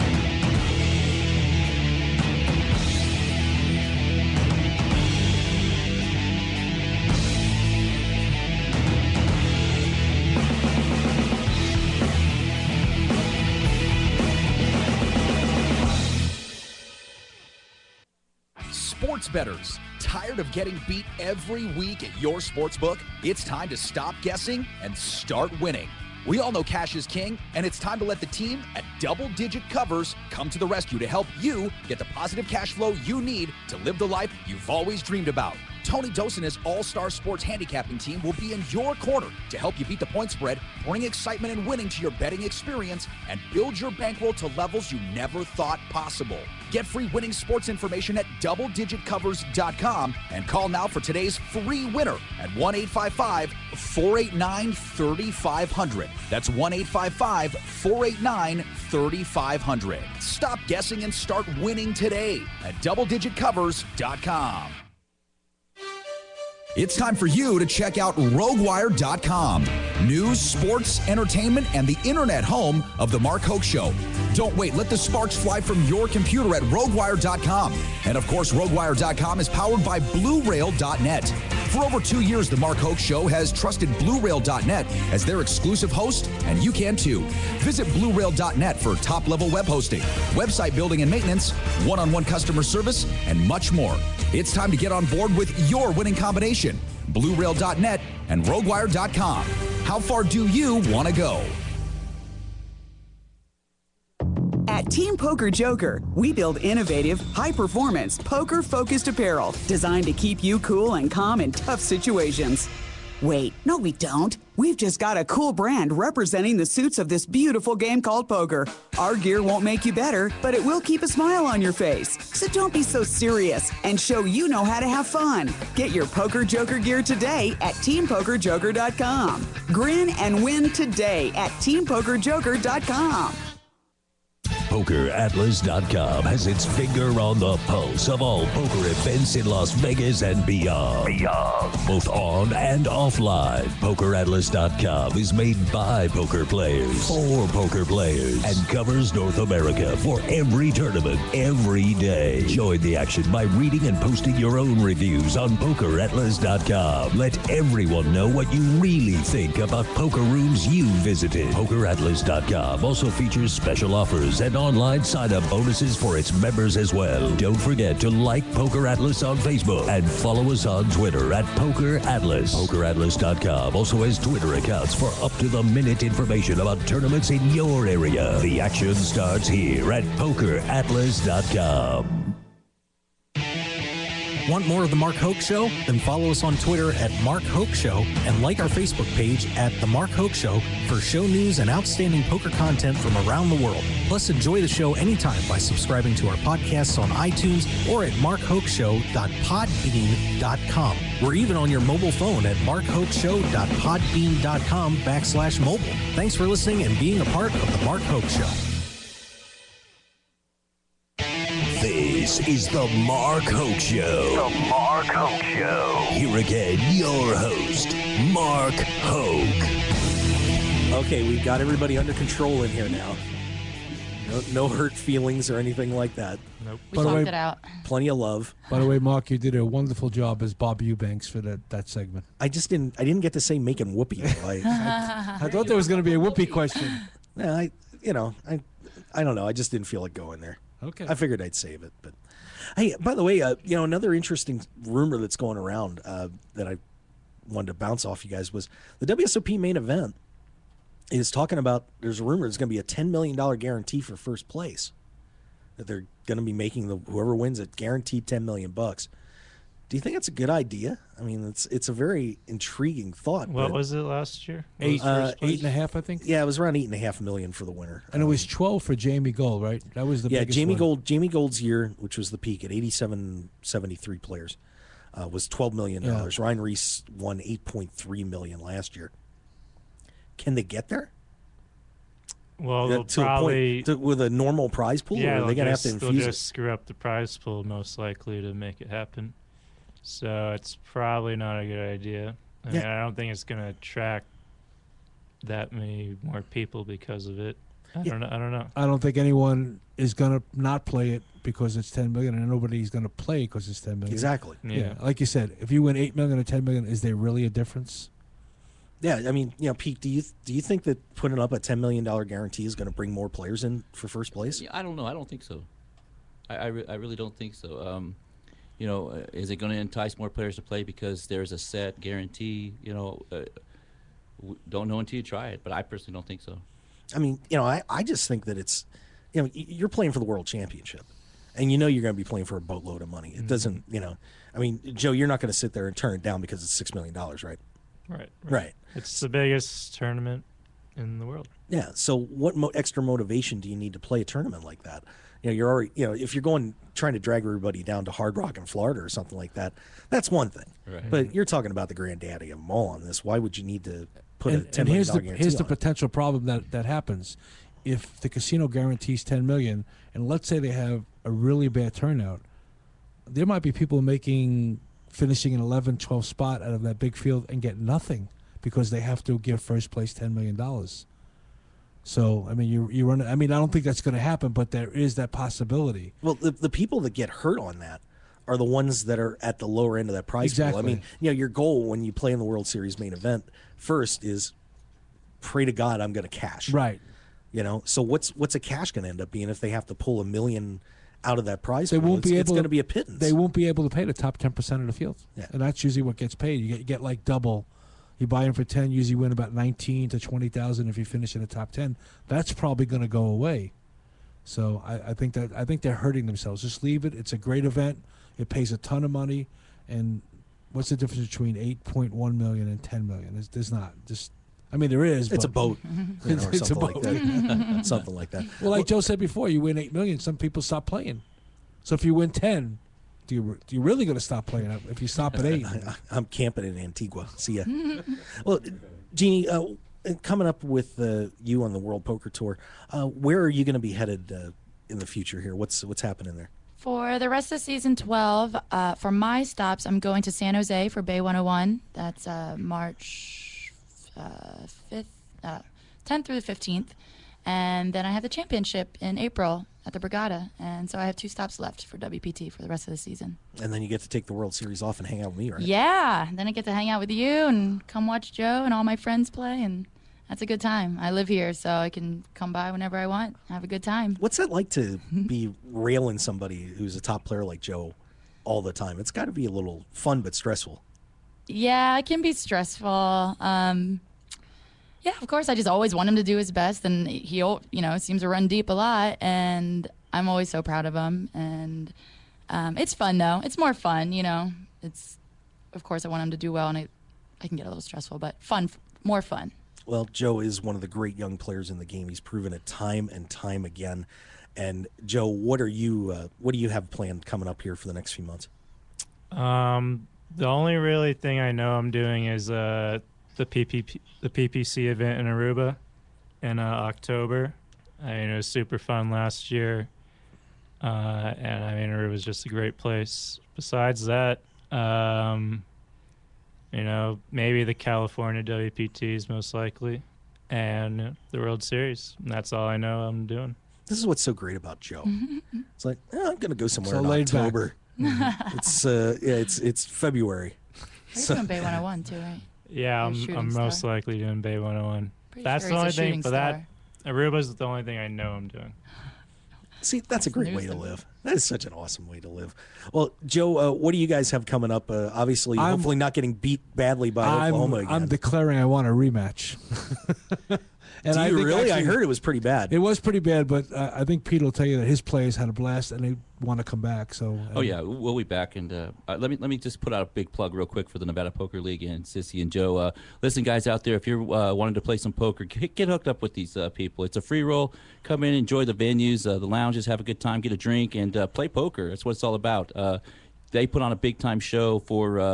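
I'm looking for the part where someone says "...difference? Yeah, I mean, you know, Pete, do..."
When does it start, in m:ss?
5:07.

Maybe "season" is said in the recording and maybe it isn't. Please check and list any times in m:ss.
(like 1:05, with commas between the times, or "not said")
7:17, 7:32.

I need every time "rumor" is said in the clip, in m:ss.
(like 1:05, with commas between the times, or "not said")
4:04, 4:12.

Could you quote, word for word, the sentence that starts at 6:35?
and that's usually what gets paid.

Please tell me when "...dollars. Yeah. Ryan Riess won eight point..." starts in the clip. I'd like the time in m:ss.
4:36.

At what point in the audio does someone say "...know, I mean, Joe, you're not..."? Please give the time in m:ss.
5:34.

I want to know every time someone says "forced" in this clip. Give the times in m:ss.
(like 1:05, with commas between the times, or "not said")
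not said.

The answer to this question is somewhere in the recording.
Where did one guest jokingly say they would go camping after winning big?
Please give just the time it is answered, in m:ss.
7:06.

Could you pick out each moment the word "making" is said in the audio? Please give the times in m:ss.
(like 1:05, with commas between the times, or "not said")
3:53, 4:16, 6:04.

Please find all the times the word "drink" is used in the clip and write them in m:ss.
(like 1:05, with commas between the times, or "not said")
9:30.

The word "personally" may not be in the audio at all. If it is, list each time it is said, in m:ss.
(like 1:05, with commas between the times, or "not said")
5:25.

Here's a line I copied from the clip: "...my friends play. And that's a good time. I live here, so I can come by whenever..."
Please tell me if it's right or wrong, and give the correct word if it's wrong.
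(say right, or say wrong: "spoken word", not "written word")
right.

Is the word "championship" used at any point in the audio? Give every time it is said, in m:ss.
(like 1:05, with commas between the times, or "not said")
5:30, 7:28.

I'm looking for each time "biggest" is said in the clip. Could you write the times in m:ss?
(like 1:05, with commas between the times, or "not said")
5:39.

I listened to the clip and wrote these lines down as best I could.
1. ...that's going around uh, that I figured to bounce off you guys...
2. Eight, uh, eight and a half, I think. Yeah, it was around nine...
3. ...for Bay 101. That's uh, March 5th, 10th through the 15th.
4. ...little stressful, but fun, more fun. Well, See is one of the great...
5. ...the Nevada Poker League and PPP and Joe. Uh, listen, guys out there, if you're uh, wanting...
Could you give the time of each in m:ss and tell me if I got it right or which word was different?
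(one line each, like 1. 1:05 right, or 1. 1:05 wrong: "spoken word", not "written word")
1. 4:05 wrong: "wanted", not "figured"
2. 4:24 wrong: "eight", not "nine"
3. 7:20 right
4. 8:07 wrong: "Joe", not "See"
5. 9:20 wrong: "Sissy", not "PPP".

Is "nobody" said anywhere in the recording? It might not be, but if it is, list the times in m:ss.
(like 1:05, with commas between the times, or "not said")
5:02.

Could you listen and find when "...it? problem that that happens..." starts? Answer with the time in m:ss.
5:56.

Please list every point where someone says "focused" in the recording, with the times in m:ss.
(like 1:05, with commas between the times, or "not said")
1:48.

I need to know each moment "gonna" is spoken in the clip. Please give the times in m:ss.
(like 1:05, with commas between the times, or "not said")
4:45, 8:46.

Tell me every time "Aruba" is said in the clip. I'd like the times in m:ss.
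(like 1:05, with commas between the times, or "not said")
8:25, 8:31, 8:57.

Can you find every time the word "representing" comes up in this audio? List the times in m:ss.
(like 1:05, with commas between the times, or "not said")
1:55.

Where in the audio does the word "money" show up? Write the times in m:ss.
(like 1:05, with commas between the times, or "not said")
5:33, 6:49.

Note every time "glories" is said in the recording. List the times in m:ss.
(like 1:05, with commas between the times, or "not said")
not said.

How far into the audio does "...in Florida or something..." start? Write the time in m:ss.
5:48.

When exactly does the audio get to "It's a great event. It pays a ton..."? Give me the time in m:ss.
6:47.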